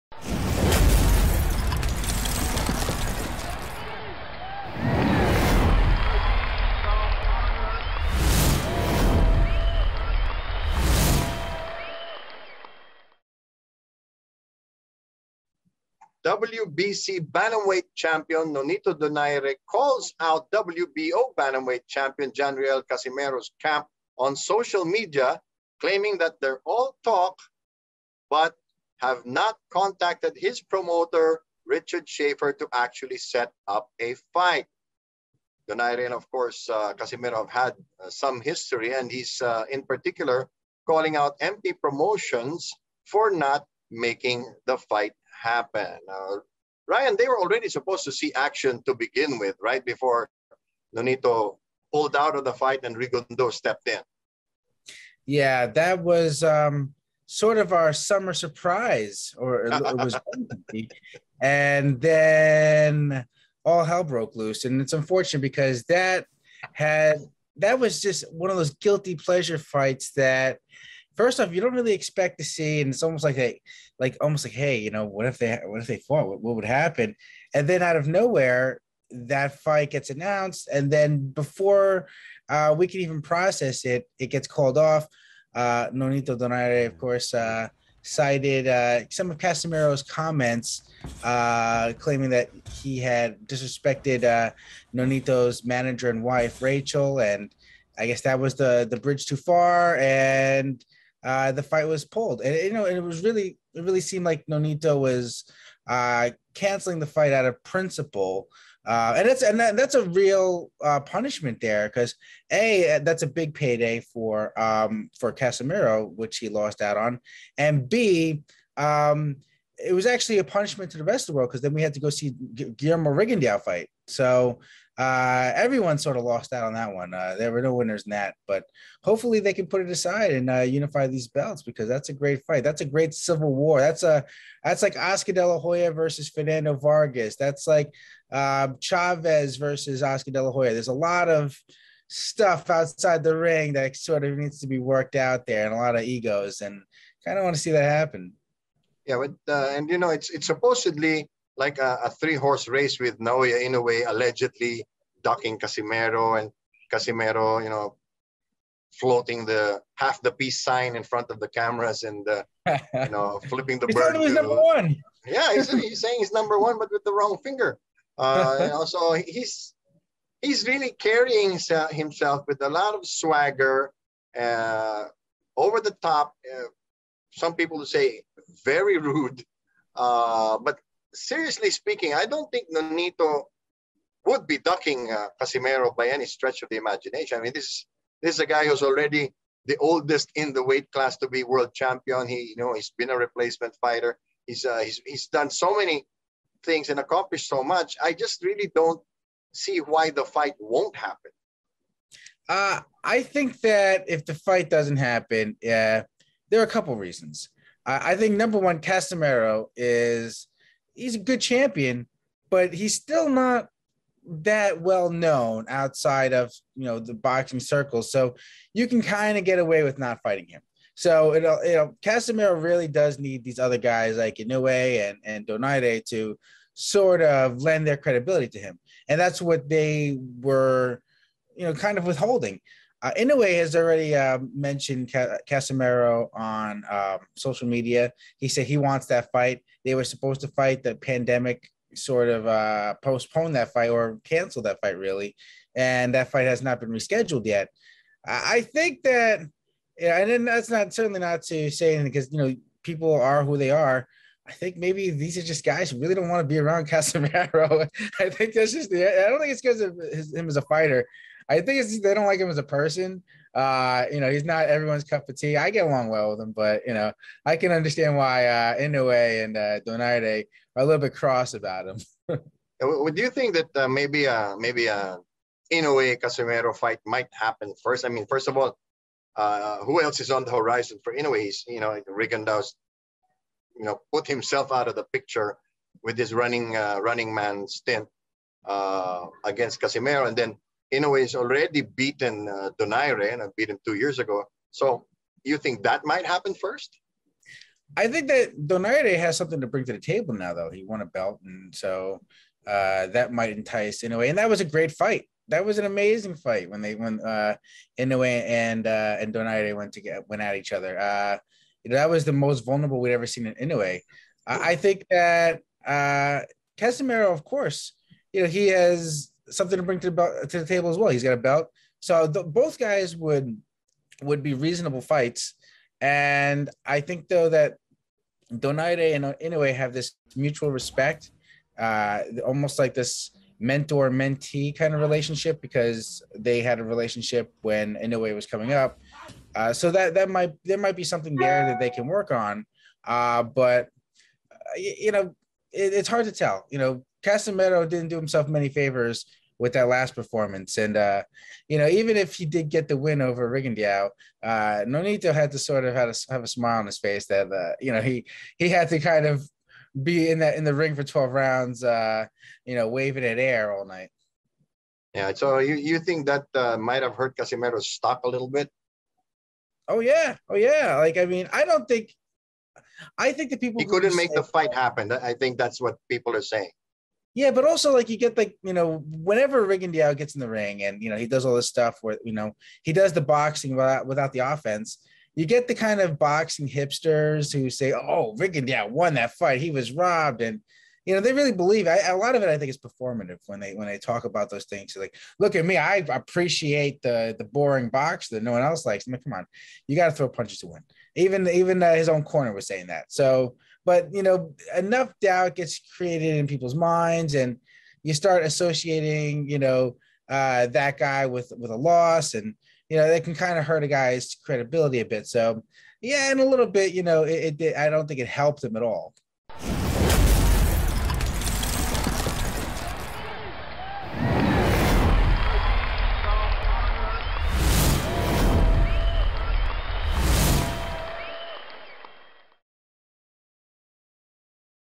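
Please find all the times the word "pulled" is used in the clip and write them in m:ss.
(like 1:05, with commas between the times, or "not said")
0:51, 1:42.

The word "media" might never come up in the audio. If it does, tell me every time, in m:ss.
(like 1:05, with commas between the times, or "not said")
0:24, 3:57.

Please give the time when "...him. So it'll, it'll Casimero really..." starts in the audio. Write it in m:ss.
3:40.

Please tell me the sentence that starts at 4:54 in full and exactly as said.
So you think that might happen first?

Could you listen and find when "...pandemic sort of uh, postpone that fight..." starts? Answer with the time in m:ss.
4:00.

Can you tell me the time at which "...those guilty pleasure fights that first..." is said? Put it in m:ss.
1:08.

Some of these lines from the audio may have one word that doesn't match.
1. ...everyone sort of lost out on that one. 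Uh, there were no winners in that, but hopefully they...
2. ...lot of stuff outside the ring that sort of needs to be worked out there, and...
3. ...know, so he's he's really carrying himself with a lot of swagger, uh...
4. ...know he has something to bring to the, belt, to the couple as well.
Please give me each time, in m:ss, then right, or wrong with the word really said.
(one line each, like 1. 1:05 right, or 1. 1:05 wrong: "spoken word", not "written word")
1. 2:05 right
2. 2:20 right
3. 2:48 right
4. 5:18 wrong: "table", not "couple".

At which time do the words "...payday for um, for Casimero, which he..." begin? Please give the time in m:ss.
1:53.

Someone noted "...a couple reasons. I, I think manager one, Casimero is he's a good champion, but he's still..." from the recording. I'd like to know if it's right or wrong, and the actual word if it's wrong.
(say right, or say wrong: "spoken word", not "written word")
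wrong: "number", not "manager".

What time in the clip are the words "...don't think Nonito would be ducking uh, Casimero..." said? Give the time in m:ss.
3:02.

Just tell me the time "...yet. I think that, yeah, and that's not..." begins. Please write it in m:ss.
4:07.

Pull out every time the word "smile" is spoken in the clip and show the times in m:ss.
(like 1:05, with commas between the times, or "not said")
5:56.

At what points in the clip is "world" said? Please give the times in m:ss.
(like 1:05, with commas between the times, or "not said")
2:01, 3:11.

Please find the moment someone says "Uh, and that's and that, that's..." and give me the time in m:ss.
1:48.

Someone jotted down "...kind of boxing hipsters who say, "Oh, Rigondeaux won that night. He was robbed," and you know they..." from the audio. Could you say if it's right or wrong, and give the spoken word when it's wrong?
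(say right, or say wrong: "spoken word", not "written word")
wrong: "fight", not "night".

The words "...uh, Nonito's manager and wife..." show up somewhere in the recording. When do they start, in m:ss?
1:34.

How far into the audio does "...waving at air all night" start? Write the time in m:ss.
6:02.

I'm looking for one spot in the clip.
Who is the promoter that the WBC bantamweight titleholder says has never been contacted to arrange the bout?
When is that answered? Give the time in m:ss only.
0:31.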